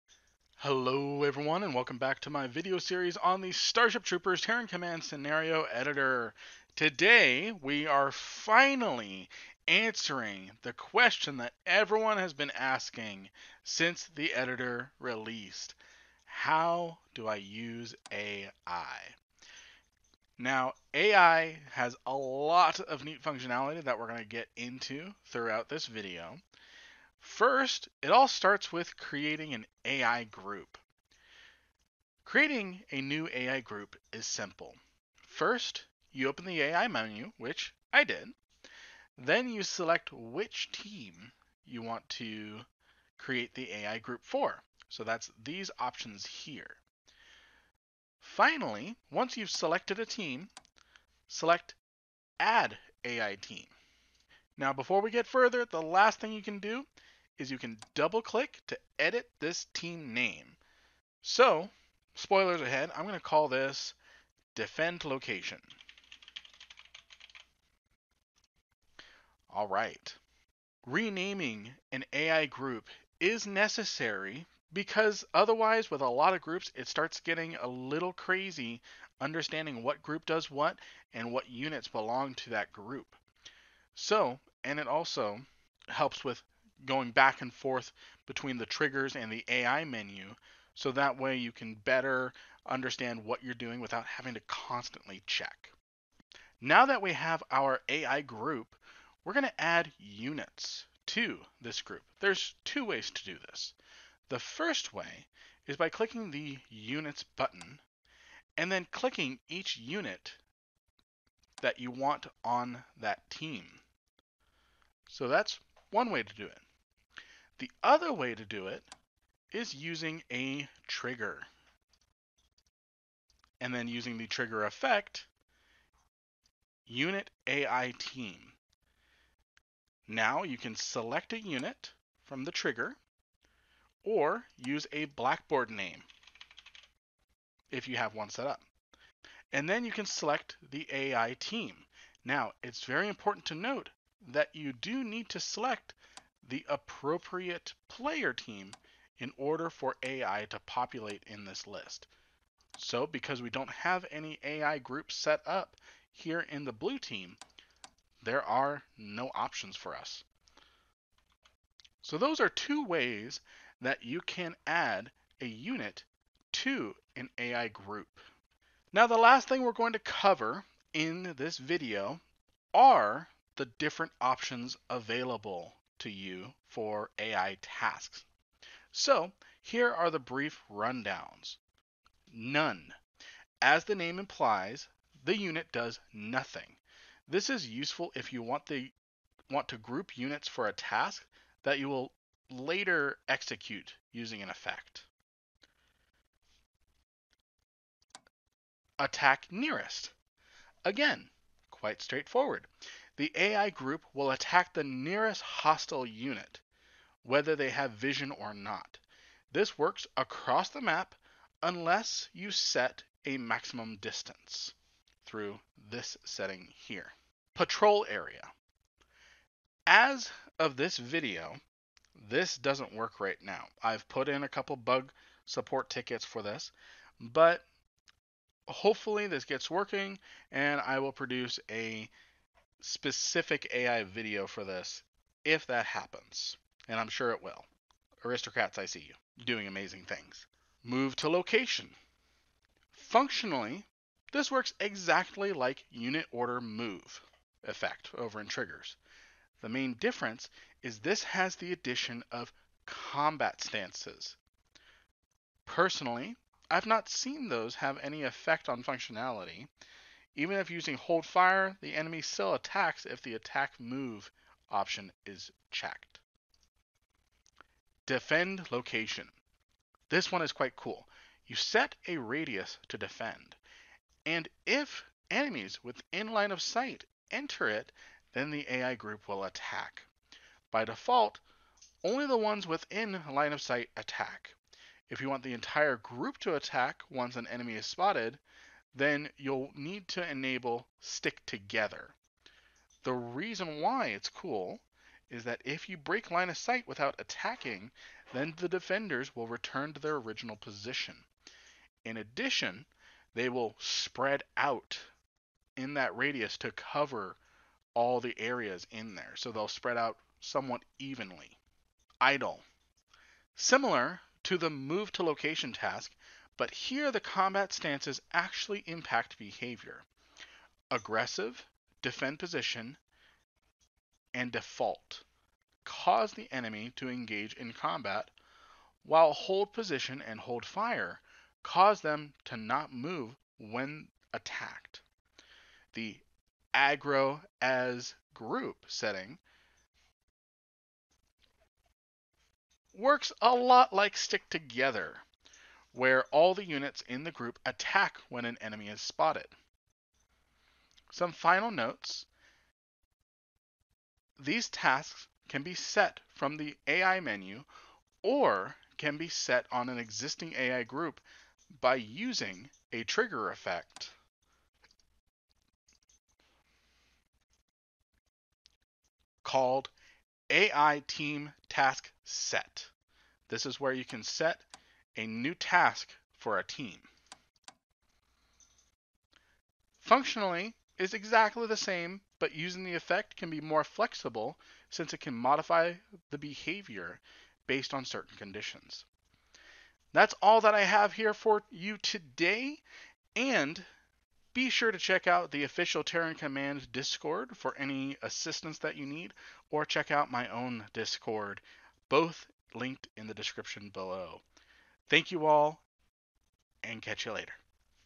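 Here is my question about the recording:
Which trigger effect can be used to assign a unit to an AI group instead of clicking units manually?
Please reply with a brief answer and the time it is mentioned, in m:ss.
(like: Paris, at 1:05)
Unit AI team, at 2:06.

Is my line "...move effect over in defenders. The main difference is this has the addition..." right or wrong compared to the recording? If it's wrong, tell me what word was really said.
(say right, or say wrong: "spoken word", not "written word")
wrong: "triggers", not "defenders".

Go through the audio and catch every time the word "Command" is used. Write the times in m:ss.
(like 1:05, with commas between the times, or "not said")
0:04, 6:36.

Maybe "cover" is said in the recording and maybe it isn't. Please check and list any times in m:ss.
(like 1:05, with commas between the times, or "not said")
2:49, 5:06.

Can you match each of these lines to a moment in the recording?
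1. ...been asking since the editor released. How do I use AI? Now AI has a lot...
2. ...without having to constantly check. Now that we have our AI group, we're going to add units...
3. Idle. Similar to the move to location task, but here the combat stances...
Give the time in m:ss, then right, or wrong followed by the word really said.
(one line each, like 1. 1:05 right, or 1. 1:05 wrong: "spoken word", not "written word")
1. 0:12 right
2. 1:33 right
3. 5:12 right.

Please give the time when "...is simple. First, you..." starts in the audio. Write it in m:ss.
0:34.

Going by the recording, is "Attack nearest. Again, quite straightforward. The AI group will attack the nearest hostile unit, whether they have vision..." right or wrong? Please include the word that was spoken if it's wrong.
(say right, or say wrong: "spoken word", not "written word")
right.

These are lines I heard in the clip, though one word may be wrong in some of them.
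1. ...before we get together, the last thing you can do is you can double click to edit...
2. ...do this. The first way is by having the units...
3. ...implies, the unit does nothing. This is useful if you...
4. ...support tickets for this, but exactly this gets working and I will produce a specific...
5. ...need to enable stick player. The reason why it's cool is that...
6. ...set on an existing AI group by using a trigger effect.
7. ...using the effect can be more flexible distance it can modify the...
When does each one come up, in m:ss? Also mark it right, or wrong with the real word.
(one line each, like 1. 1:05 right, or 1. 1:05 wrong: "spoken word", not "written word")
1. 0:54 wrong: "further", not "together"
2. 1:43 wrong: "clicking", not "having"
3. 3:04 right
4. 3:45 wrong: "hopefully", not "exactly"
5. 4:49 wrong: "together", not "player"
6. 5:59 right
7. 6:22 wrong: "since", not "distance".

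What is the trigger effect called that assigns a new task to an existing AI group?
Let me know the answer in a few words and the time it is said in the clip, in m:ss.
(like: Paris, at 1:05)
AI Team Task Set, at 6:10.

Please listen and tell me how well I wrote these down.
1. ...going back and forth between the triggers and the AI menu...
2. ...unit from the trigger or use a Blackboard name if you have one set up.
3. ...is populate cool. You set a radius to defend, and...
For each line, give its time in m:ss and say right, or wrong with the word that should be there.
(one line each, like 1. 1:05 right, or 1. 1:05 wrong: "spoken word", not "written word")
1. 1:26 right
2. 2:11 right
3. 4:30 wrong: "quite", not "populate".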